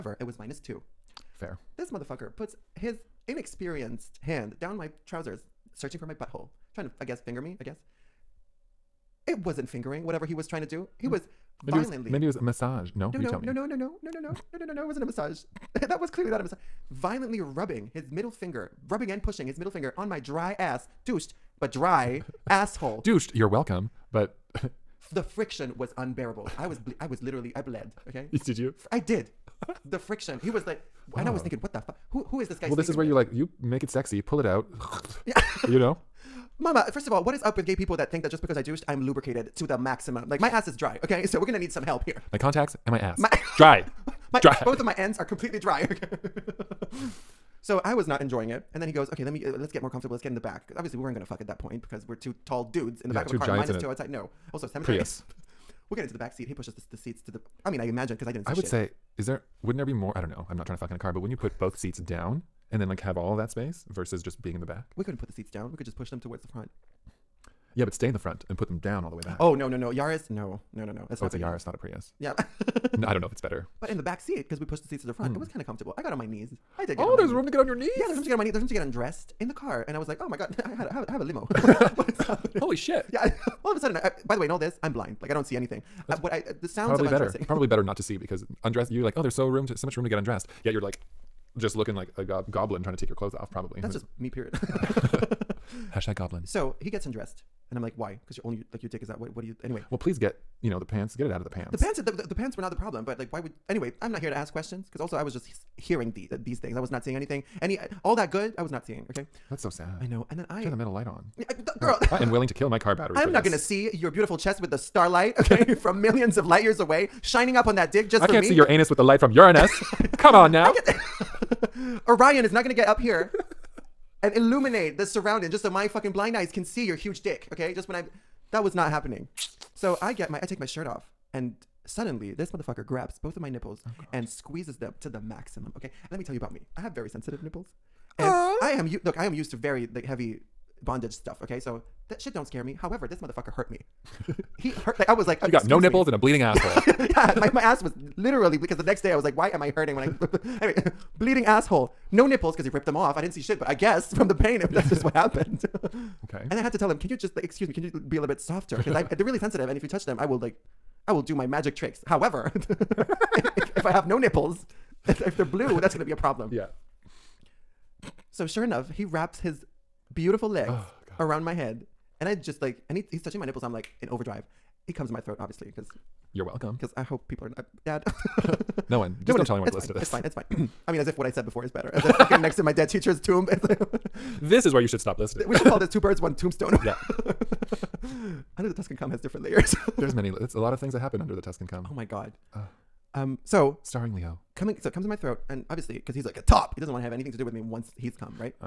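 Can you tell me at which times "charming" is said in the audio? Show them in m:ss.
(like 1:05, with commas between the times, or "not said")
not said.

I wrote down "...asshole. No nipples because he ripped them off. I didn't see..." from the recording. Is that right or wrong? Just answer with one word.
right.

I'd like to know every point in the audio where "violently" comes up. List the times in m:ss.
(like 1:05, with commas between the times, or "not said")
0:11, 0:16.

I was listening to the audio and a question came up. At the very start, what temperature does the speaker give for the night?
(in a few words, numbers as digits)
-2.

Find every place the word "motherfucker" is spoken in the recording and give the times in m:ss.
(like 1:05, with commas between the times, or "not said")
0:01, 2:12, 2:23.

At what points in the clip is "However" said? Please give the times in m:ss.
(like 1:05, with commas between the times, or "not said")
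2:22, 2:42.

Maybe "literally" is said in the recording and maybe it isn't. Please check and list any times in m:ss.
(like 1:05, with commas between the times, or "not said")
0:27, 2:28.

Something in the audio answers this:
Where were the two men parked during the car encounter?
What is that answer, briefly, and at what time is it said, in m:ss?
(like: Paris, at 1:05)
a cemetery, at 0:54.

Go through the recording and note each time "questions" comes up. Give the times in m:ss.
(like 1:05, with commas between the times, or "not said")
1:44.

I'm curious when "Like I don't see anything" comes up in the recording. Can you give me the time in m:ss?
1:25.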